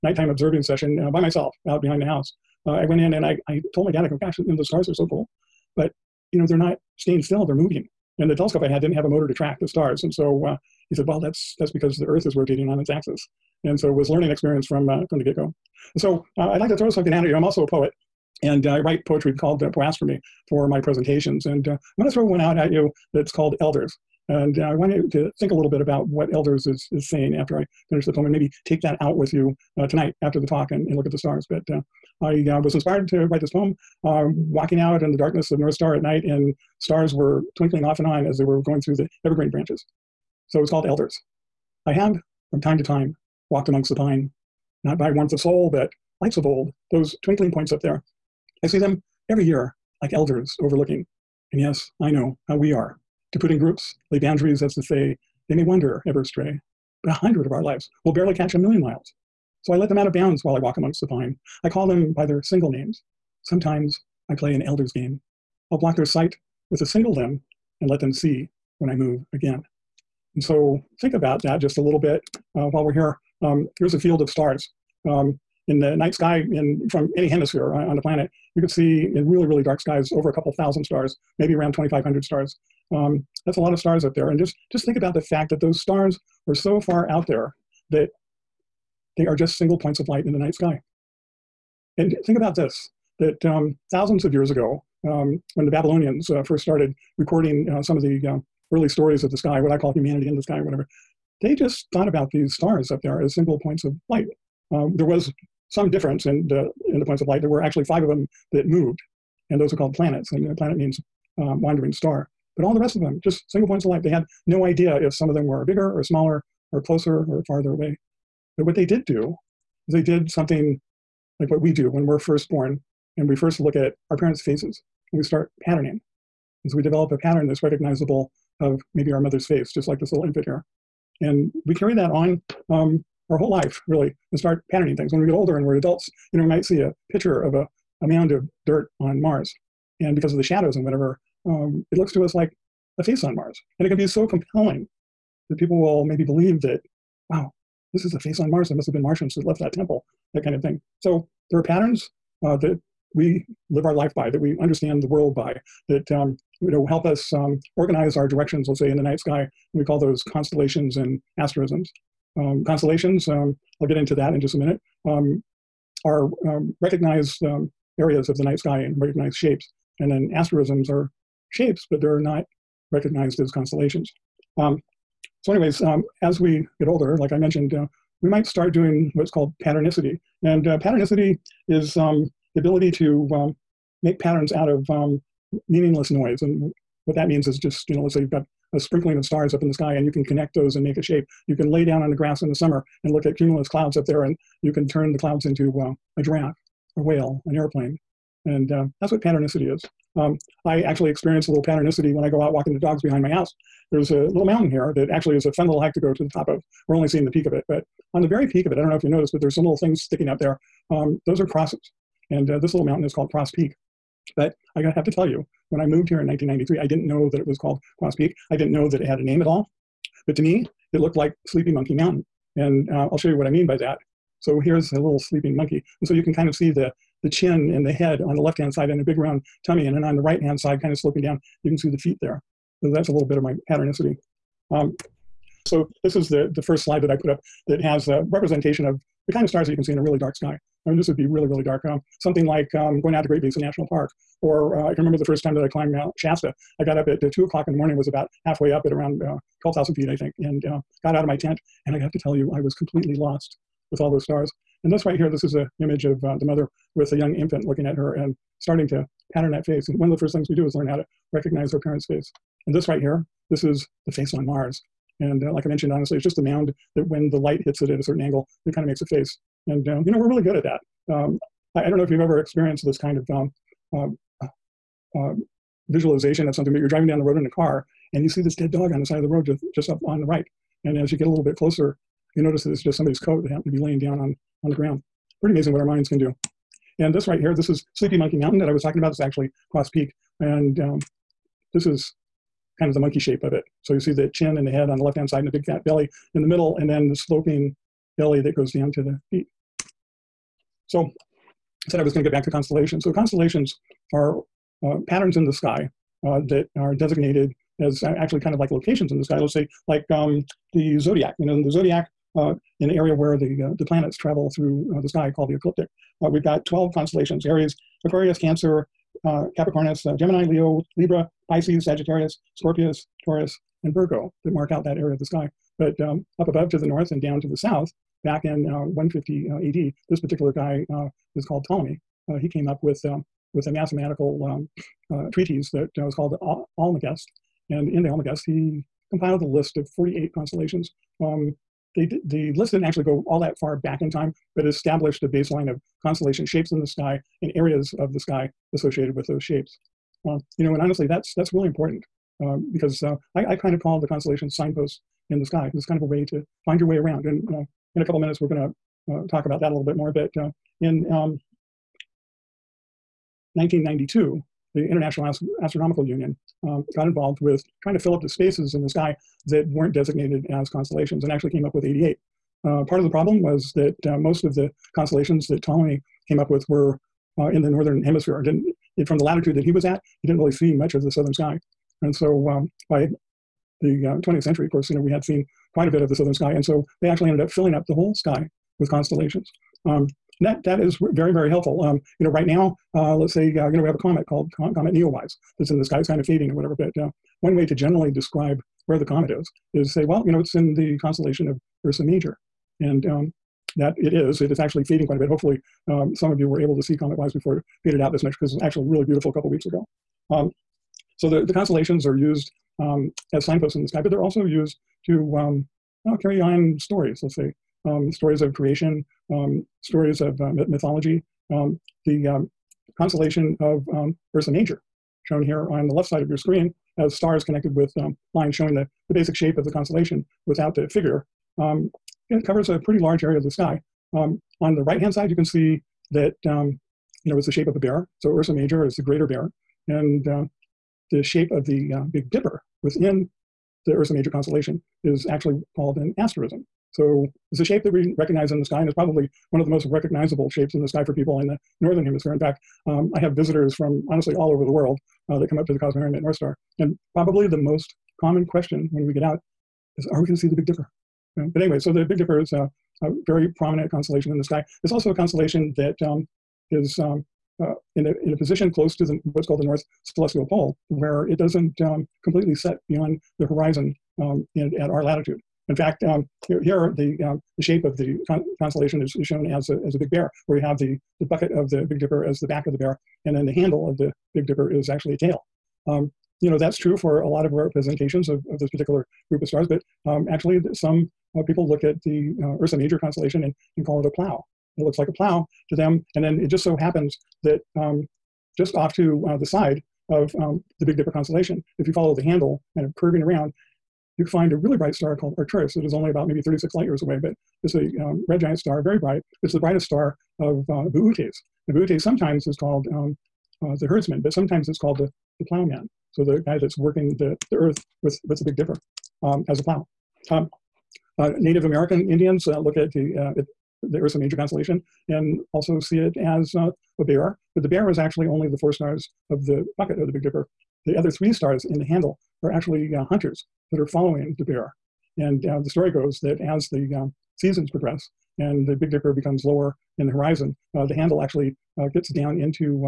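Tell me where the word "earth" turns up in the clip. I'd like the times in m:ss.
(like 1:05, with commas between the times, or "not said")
0:12, 8:37.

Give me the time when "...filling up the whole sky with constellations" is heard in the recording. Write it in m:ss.
6:27.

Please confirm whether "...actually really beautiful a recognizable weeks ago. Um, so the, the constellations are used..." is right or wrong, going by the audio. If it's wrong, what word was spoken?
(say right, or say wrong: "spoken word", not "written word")
wrong: "couple", not "recognizable".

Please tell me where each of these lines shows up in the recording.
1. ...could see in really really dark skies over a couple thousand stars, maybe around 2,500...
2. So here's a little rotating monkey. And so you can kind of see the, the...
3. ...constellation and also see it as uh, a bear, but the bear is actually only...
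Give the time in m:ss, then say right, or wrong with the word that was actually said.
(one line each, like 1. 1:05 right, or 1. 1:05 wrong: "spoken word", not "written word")
1. 1:18 right
2. 3:44 wrong: "sleeping", not "rotating"
3. 8:44 right.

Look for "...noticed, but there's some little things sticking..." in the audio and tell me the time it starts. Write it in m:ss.
3:29.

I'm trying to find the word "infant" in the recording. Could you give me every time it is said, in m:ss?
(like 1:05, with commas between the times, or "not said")
2:10, 4:17.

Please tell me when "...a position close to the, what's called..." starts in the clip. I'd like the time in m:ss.
7:48.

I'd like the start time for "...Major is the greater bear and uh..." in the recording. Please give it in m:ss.
7:18.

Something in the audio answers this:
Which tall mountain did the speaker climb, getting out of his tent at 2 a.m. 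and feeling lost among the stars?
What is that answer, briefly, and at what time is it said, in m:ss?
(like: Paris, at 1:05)
Mount Shasta, at 4:05.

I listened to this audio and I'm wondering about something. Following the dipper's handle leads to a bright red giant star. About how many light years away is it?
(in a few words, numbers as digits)
36.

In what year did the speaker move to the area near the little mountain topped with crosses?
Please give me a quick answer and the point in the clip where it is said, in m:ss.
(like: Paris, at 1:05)
1993, at 3:36.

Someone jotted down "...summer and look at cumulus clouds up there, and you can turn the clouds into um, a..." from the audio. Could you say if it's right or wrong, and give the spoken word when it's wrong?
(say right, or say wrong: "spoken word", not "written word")
right.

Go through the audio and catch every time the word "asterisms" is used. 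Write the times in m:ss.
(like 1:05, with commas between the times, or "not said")
2:41, 2:50, 7:26.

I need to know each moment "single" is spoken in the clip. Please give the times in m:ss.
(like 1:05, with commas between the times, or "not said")
1:02, 1:06, 1:29, 1:43, 1:53.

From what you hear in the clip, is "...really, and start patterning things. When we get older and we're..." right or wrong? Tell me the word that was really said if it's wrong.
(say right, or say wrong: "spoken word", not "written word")
right.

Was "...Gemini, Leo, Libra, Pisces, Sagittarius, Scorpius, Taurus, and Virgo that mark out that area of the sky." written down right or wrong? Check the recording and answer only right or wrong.
right.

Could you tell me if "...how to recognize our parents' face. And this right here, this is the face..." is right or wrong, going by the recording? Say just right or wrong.
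right.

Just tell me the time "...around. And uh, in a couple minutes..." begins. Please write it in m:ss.
5:56.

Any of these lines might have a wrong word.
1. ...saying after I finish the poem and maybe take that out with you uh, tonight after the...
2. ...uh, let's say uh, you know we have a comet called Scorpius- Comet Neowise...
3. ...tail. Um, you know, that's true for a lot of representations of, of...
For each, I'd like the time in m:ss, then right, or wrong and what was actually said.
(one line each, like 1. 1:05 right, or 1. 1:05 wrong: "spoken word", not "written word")
1. 0:27 right
2. 6:32 wrong: "Com", not "Scorpius"
3. 8:05 right.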